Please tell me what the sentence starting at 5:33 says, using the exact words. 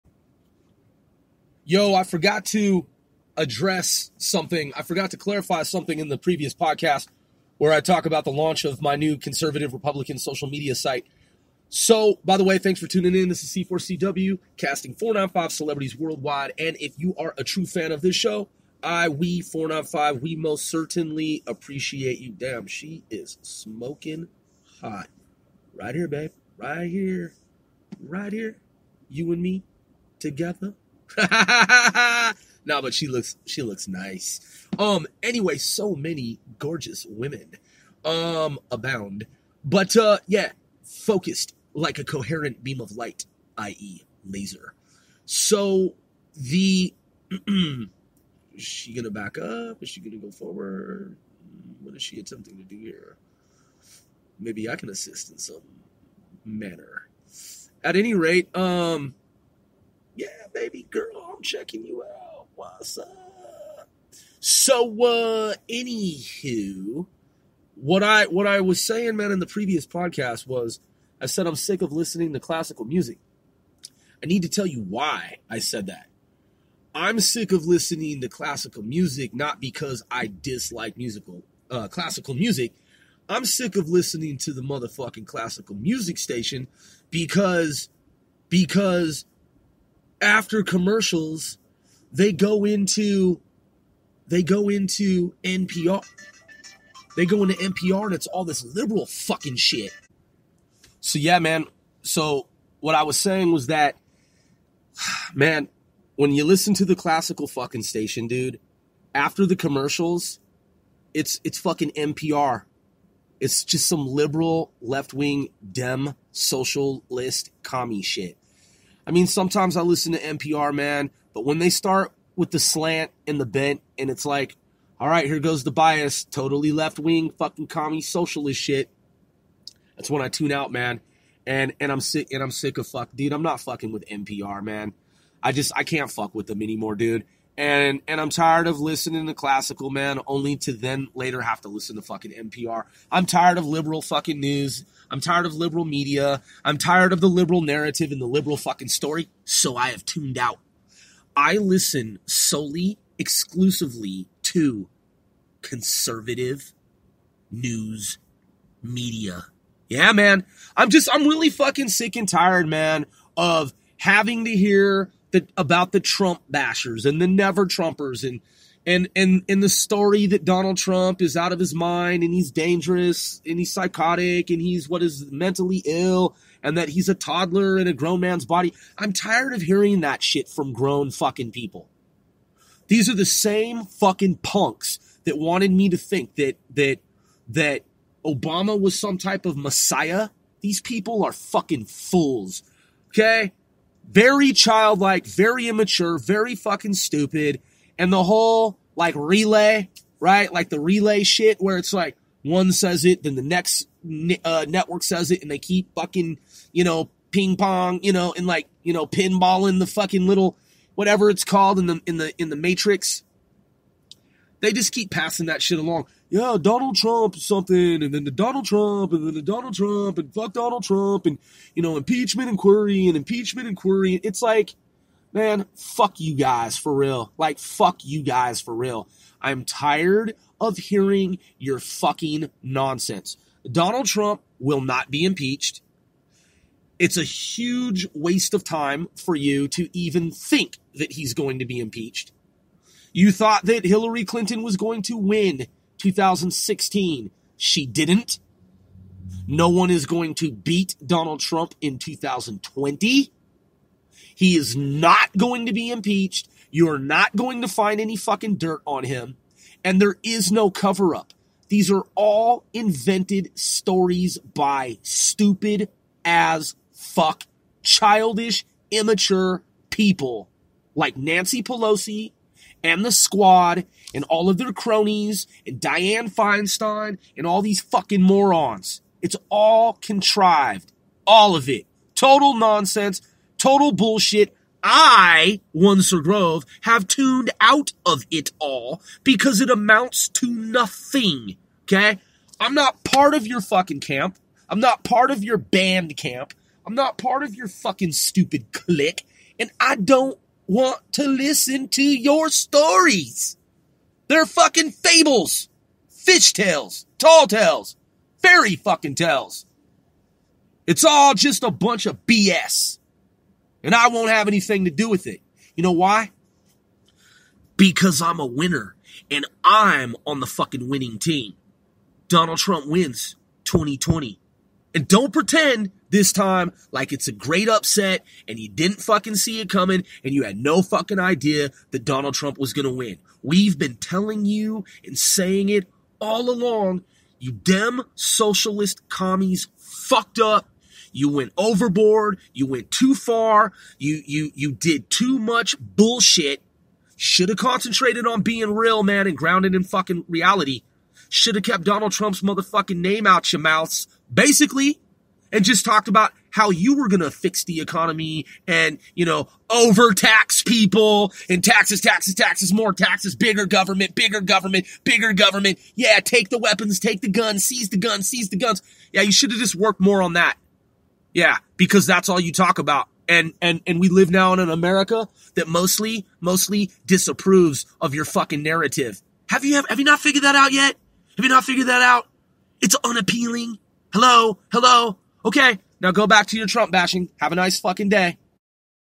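We've been telling you and saying it all along.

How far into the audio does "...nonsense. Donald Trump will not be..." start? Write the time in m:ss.
3:52.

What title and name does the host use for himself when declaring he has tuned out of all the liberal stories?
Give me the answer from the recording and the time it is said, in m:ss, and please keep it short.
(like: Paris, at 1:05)
Sir Grove, at 4:46.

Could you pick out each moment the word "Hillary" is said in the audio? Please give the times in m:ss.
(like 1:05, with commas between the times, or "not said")
4:03.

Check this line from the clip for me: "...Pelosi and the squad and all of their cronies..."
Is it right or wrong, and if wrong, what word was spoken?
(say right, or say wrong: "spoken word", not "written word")
right.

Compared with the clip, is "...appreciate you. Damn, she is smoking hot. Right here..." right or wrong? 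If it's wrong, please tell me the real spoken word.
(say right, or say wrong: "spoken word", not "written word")
right.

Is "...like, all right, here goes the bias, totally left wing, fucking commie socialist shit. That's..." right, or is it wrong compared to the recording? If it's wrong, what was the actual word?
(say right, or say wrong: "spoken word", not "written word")
right.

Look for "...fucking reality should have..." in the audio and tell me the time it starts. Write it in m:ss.
5:49.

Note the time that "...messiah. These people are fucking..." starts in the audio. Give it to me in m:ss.
3:09.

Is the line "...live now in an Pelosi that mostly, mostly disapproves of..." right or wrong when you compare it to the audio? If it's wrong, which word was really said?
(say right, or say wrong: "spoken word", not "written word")
wrong: "America", not "Pelosi".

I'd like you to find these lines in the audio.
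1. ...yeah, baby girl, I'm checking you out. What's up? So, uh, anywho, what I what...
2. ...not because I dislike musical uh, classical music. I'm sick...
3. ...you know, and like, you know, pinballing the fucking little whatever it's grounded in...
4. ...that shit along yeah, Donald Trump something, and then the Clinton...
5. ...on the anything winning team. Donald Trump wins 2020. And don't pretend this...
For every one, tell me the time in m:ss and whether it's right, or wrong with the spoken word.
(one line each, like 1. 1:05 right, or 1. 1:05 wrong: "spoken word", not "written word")
1. 1:00 right
2. 1:19 right
3. 3:28 wrong: "called", not "grounded"
4. 3:35 wrong: "Donald", not "Clinton"
5. 5:20 wrong: "fucking", not "anything".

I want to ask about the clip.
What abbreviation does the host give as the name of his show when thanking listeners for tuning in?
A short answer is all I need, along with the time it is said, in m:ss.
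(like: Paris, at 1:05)
C4CW, at 0:13.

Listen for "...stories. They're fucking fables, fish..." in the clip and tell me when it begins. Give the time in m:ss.
5:02.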